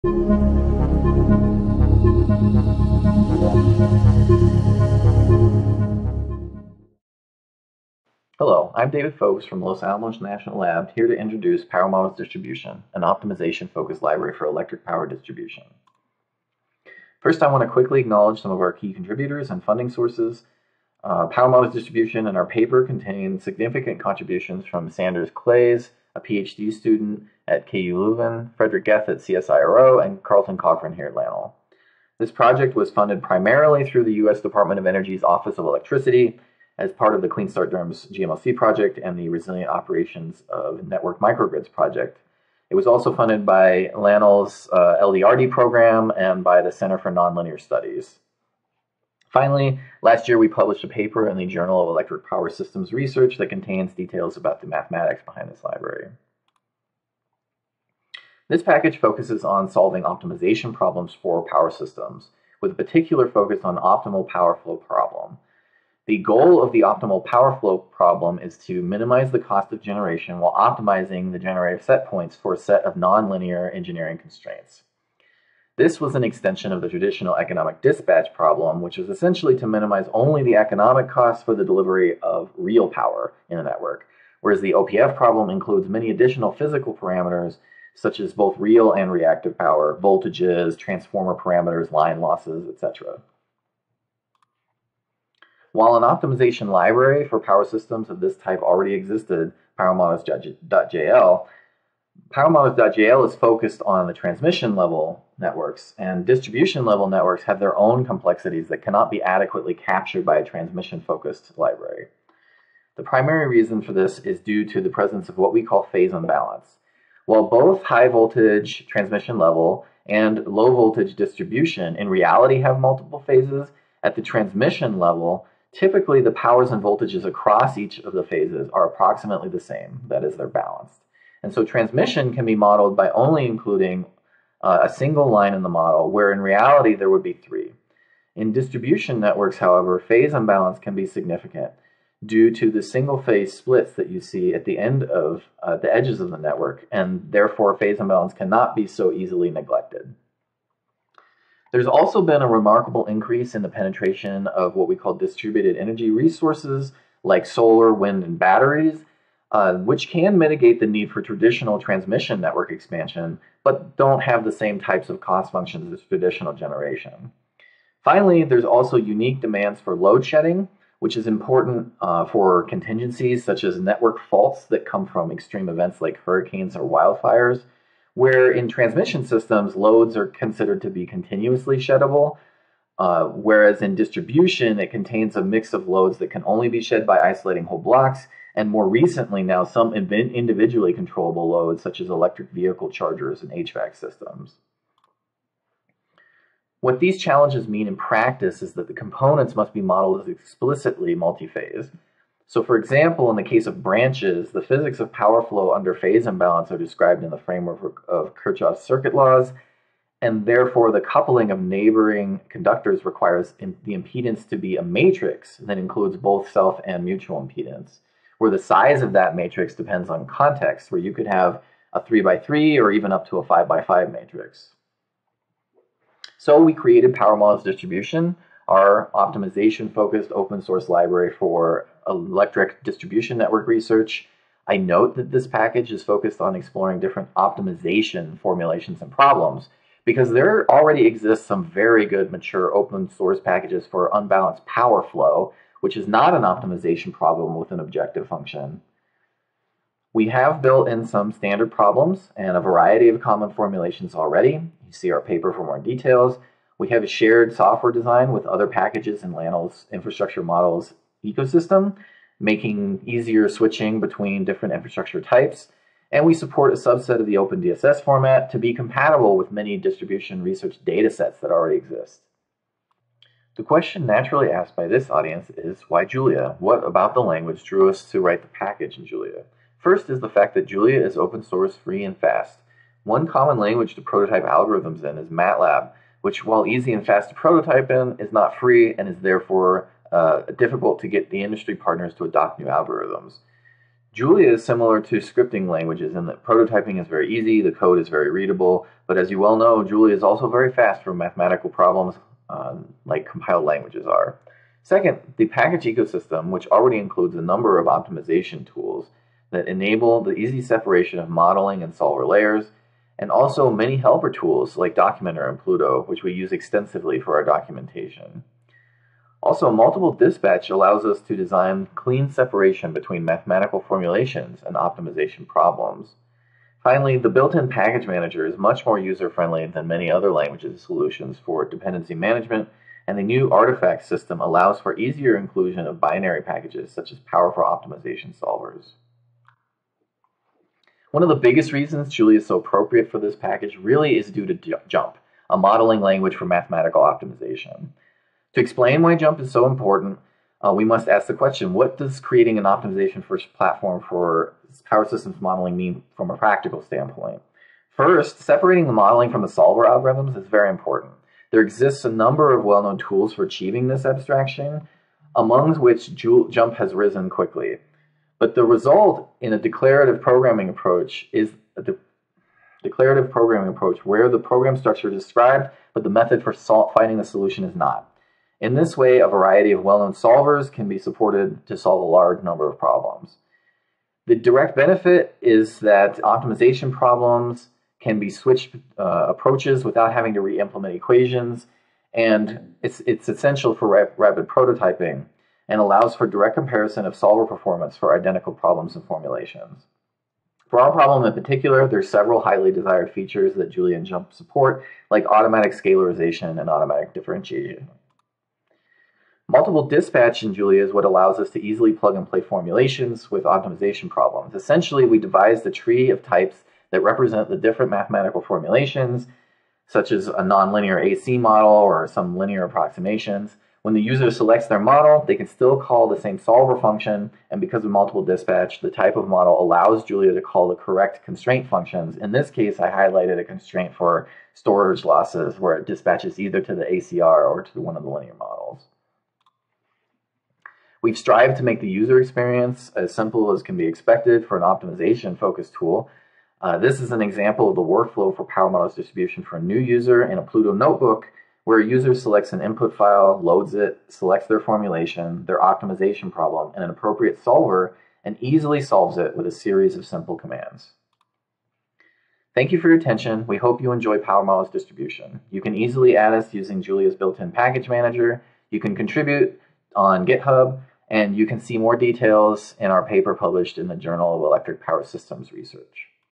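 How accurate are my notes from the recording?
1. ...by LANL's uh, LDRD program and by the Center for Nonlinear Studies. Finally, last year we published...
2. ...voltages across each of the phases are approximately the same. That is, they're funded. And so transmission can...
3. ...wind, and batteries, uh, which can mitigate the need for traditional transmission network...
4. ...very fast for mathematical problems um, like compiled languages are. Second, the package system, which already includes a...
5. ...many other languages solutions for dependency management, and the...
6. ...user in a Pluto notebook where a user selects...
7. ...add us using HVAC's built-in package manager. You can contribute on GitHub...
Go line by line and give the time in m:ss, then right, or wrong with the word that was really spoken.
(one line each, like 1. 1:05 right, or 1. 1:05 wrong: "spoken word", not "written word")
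1. 0:43 right
2. 2:06 wrong: "balanced", not "funded"
3. 2:37 right
4. 5:00 wrong: "ecosystem", not "system"
5. 5:29 right
6. 7:29 right
7. 7:46 wrong: "Julia", not "HVAC".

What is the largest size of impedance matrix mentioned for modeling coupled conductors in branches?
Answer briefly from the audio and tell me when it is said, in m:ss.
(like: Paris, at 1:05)
5 by 5, at 3:43.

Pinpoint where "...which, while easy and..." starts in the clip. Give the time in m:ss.
4:46.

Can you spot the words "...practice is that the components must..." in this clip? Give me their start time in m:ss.
3:17.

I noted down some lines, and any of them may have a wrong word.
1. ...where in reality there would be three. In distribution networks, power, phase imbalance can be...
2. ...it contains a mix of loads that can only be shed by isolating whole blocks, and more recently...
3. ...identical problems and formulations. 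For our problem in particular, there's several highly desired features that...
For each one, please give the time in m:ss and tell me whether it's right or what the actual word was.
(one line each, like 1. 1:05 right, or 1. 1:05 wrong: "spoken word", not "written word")
1. 2:16 wrong: "however", not "power"
2. 3:04 right
3. 6:38 right.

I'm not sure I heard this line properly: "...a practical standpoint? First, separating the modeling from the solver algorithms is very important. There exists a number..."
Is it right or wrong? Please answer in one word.
right.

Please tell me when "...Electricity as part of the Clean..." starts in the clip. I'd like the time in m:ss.
0:35.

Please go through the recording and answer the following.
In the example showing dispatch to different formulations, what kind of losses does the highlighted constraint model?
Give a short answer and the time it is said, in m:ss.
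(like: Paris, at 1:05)
storage losses, at 7:14.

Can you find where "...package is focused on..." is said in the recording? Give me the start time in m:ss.
3:55.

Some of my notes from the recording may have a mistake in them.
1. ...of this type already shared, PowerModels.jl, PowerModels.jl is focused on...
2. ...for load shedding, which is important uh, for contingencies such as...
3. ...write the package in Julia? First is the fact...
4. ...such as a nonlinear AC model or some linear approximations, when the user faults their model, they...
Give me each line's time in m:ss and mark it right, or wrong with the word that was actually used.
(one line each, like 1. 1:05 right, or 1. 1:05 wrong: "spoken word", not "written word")
1. 1:38 wrong: "existed", not "shared"
2. 2:49 right
3. 4:38 right
4. 6:59 wrong: "selects", not "faults".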